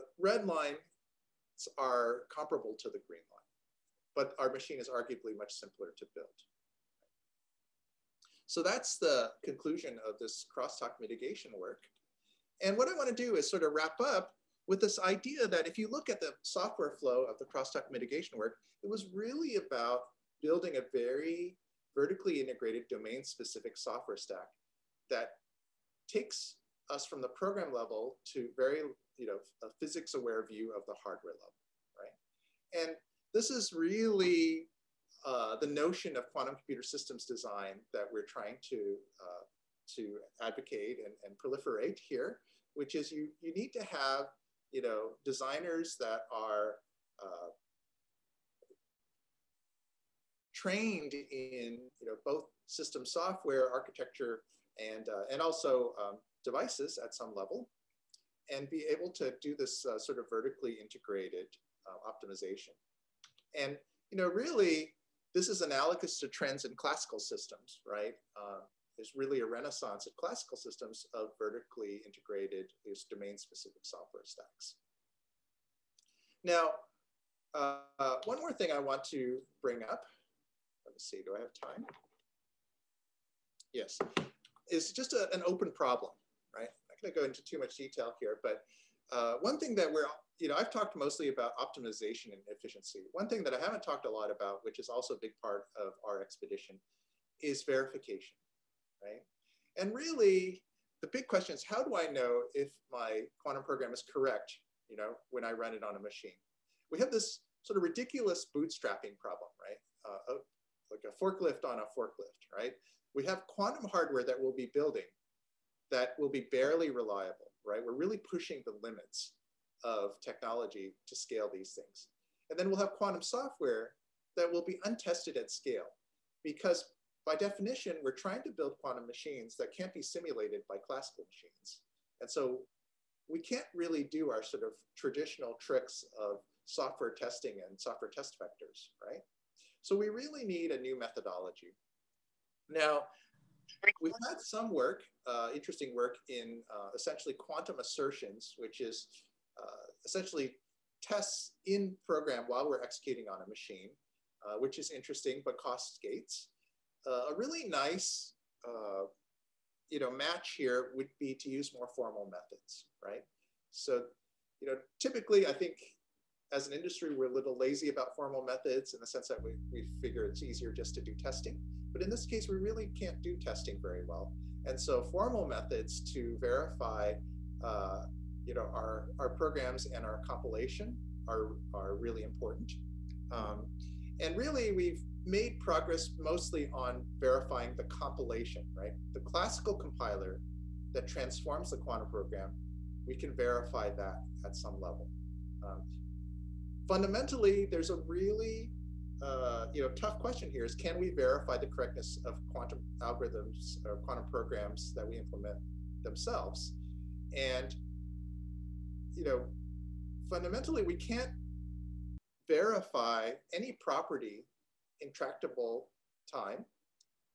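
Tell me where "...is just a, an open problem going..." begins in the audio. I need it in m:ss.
1:24.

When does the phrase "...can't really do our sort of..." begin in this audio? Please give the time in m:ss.
2:13.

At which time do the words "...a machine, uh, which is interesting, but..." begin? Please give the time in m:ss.
2:33.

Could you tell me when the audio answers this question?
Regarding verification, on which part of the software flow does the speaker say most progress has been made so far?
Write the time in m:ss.
3:07.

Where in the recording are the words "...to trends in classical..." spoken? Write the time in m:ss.
1:06.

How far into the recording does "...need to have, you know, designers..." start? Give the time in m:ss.
0:43.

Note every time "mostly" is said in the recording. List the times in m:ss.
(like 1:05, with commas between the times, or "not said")
1:30, 3:06.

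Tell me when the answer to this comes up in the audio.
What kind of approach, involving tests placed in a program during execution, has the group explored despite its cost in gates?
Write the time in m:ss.
2:27.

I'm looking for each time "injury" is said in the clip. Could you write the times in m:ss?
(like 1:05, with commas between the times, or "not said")
not said.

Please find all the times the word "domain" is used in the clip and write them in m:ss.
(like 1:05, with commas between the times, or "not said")
0:22, 1:13.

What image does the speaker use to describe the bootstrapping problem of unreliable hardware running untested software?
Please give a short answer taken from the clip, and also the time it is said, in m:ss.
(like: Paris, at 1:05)
A forklift on a forklift, at 1:51.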